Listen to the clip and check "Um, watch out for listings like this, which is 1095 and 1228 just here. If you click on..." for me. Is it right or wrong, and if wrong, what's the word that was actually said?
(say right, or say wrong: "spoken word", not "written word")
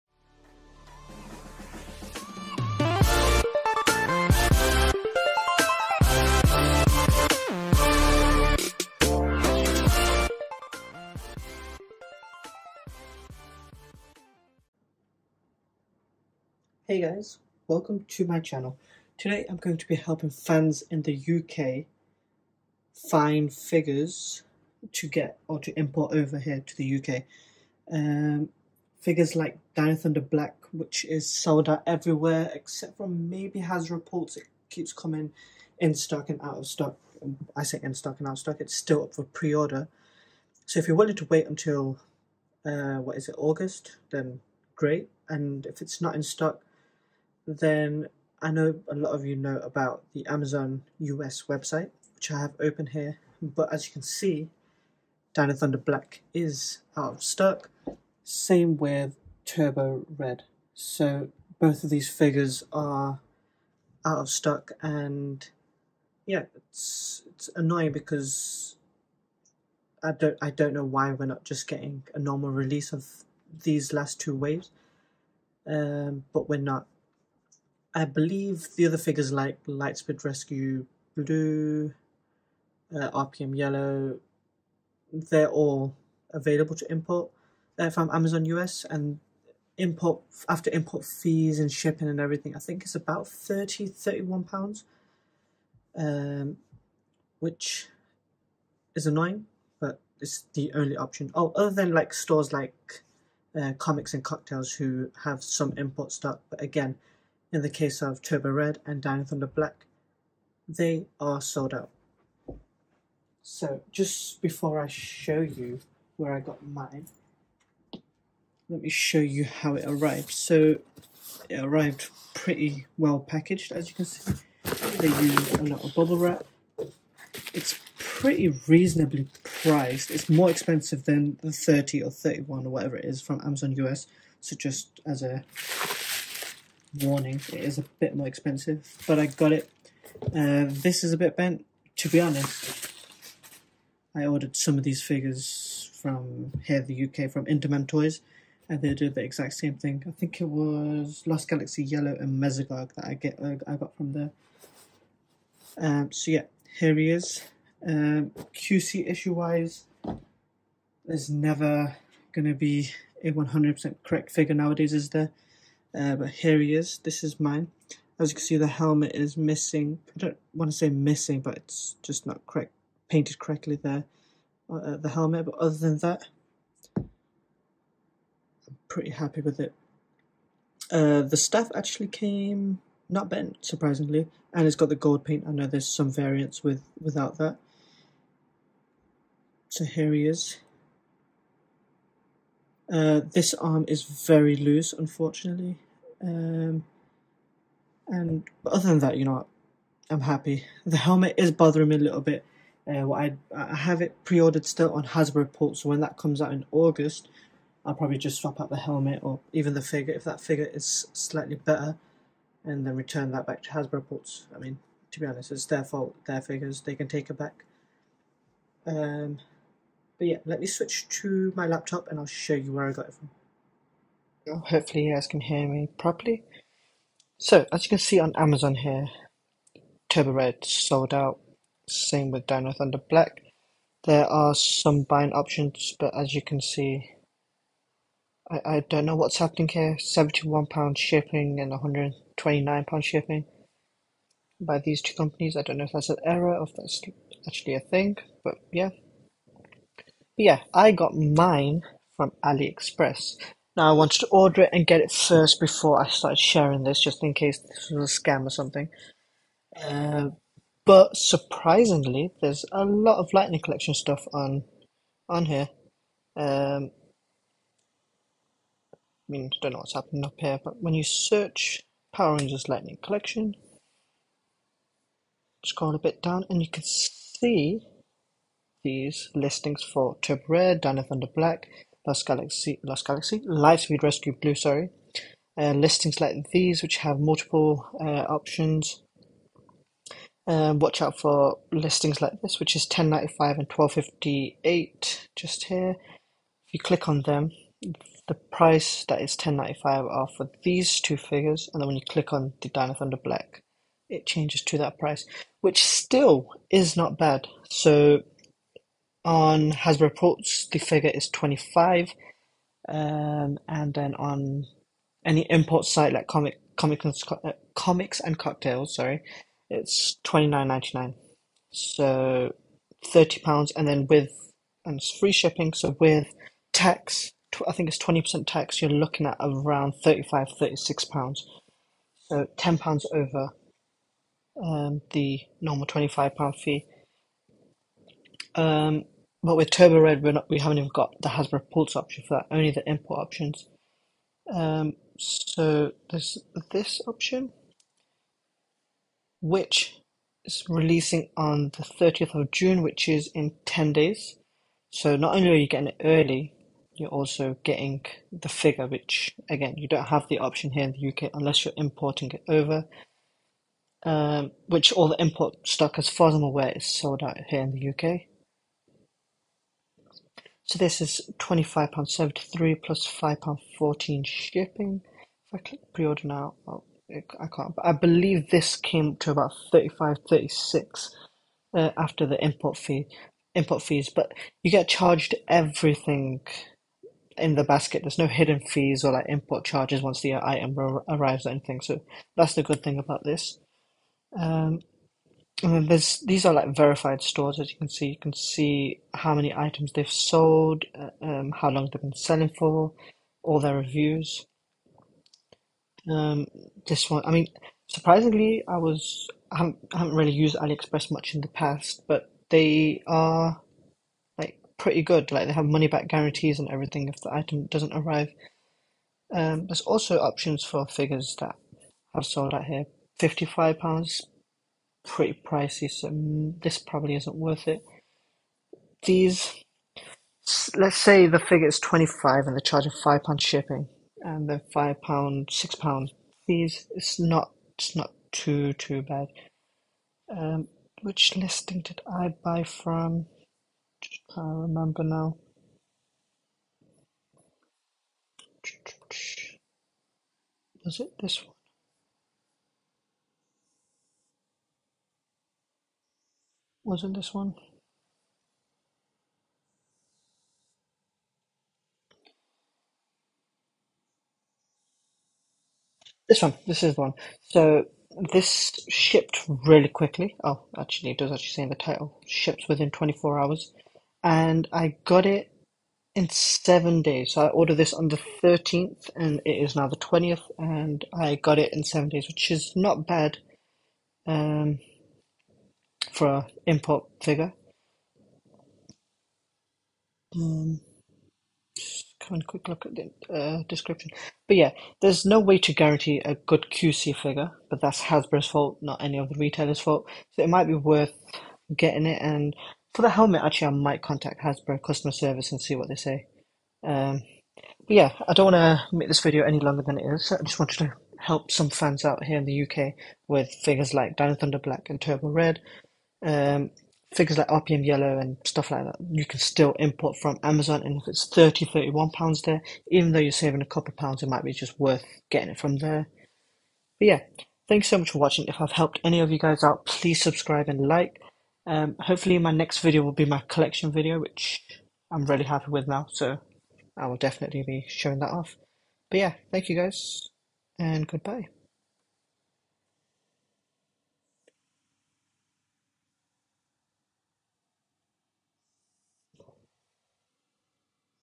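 wrong: "1258", not "1228".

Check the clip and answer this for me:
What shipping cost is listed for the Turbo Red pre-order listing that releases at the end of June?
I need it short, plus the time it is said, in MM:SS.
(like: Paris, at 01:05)
£5.14, at 06:13.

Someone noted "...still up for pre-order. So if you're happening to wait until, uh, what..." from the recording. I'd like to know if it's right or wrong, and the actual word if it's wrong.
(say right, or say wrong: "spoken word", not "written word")
wrong: "willing", not "happening".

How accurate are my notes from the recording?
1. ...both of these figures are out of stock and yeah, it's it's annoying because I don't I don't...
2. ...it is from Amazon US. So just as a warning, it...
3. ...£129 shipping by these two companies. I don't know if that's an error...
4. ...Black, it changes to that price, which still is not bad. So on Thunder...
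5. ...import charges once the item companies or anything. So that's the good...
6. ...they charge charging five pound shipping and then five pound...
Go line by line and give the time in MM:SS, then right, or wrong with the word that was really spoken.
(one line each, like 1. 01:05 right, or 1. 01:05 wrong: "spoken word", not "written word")
1. 01:01 right
2. 02:12 right
3. 04:02 right
4. 05:03 wrong: "Hasbro", not "Thunder"
5. 06:29 wrong: "arrives", not "companies"
6. 07:12 right.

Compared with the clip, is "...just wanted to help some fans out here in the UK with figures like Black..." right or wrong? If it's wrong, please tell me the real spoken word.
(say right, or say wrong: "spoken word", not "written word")
wrong: "Dino", not "Black".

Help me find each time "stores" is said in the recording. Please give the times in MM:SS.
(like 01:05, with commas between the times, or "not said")
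01:42, 06:37.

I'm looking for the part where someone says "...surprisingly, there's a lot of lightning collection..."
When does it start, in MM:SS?
04:21.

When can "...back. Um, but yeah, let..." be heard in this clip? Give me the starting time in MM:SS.
03:37.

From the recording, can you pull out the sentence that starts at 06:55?
Like they have money back guarantees and everything if the item doesn't arrive.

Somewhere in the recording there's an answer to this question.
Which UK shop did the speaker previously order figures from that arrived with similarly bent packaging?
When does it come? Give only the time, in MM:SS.
02:27.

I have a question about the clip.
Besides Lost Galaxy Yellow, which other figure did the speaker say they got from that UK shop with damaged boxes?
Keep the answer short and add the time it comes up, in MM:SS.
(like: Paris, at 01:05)
Mesogog, at 02:32.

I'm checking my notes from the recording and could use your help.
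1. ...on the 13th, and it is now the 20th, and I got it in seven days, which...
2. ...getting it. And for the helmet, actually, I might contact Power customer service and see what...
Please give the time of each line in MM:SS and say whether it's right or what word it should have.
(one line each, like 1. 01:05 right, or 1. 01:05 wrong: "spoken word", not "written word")
1. 07:57 right
2. 08:21 wrong: "Hasbro", not "Power".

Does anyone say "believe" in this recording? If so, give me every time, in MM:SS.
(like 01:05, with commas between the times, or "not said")
01:18, 06:17.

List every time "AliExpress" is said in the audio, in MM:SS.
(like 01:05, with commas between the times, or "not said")
04:12, 06:50.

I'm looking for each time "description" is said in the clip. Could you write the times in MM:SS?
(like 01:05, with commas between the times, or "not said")
08:13.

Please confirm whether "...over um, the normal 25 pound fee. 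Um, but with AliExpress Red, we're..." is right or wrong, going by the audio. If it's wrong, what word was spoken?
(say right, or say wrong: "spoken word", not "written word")
wrong: "Turbo", not "AliExpress".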